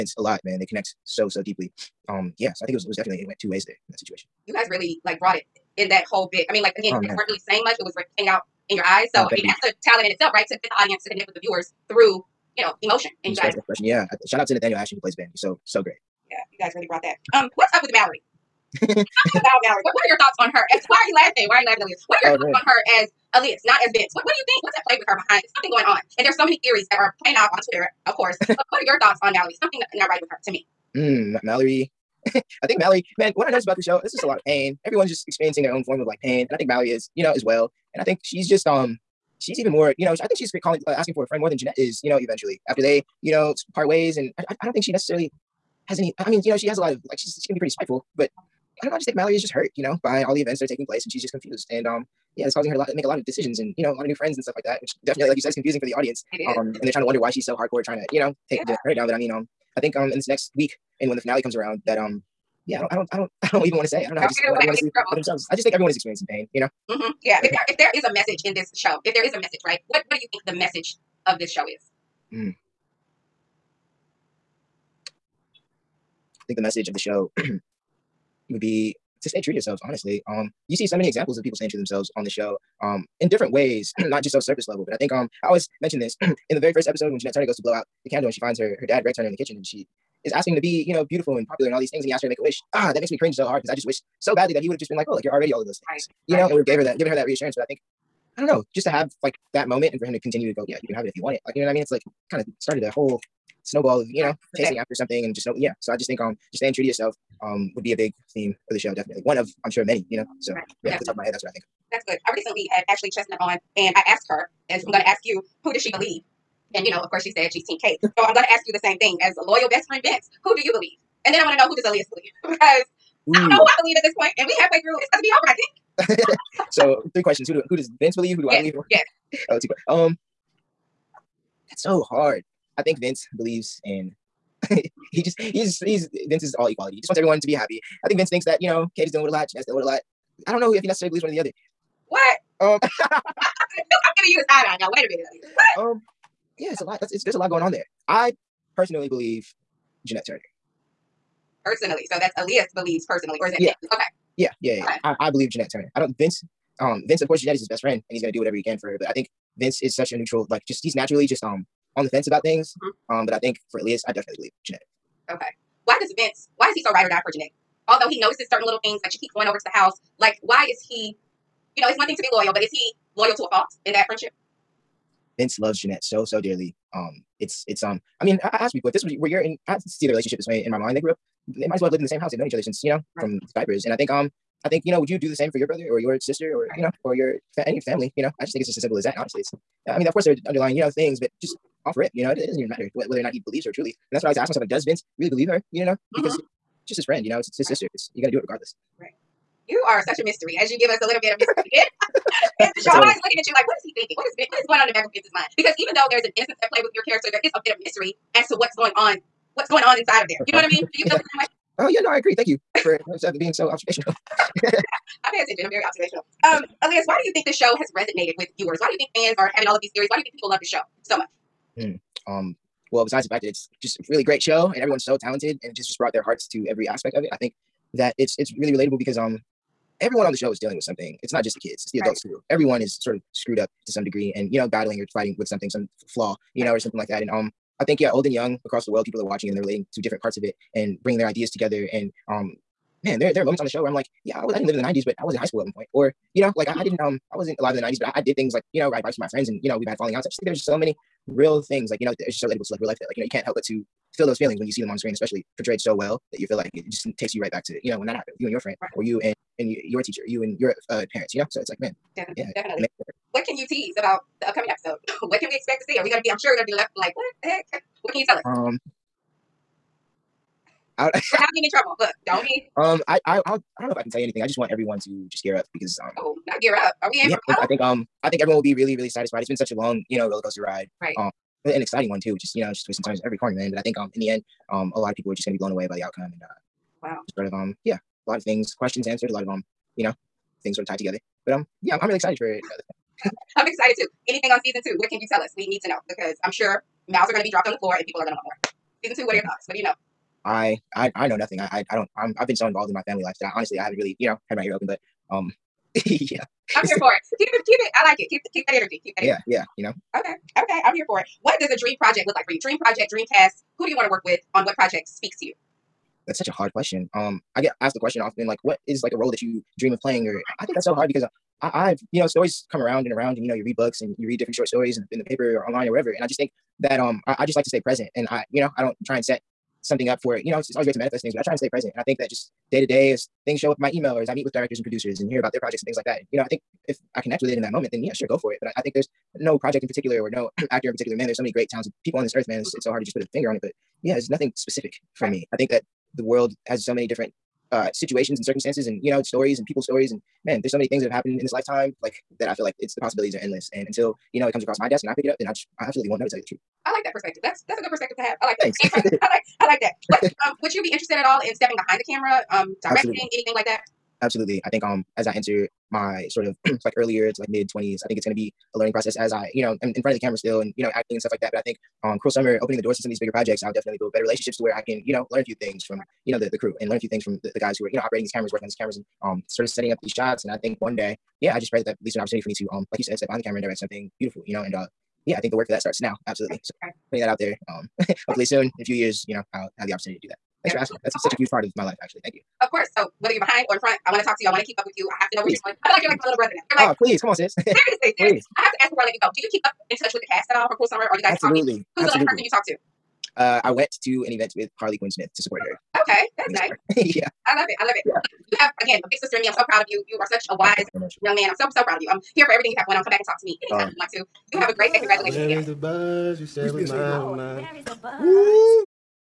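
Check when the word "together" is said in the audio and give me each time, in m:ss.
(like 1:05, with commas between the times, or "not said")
4:01, 4:50.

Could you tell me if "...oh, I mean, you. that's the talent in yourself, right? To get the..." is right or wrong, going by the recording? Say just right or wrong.
wrong.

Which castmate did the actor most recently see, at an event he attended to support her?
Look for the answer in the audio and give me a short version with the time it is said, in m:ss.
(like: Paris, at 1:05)
Harley Quinn Smith, at 6:44.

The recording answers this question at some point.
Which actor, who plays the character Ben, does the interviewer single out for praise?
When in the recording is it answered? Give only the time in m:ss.
0:14.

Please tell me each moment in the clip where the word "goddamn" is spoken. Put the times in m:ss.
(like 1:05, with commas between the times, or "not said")
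not said.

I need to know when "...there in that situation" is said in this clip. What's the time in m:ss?
0:03.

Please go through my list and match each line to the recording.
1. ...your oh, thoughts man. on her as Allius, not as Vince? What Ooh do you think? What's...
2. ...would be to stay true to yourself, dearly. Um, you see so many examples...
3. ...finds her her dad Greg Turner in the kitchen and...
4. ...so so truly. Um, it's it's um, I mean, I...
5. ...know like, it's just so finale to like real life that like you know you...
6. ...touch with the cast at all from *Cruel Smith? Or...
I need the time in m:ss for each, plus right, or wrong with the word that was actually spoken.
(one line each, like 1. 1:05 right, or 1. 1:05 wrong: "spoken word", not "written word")
1. 0:22 wrong: "What", not "Ooh"
2. 1:18 wrong: "honestly", not "dearly"
3. 1:28 right
4. 2:56 wrong: "dearly", not "truly"
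5. 4:12 wrong: "relatable", not "finale"
6. 6:39 wrong: "Summer", not "Smith".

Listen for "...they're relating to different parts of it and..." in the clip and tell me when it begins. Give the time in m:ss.
3:59.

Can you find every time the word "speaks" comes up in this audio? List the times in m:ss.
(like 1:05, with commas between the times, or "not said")
5:15.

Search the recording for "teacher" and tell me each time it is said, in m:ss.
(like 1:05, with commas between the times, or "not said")
4:20.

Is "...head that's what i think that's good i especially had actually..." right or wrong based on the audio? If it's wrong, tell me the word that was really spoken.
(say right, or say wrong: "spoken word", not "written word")
wrong: "recently", not "especially".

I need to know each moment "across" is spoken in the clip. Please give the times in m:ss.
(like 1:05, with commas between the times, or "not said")
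3:58, 5:54.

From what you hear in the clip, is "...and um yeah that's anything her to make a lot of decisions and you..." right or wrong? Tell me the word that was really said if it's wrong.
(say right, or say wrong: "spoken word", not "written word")
wrong: "causing", not "anything".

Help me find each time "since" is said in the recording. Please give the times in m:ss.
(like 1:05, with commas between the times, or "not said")
3:02.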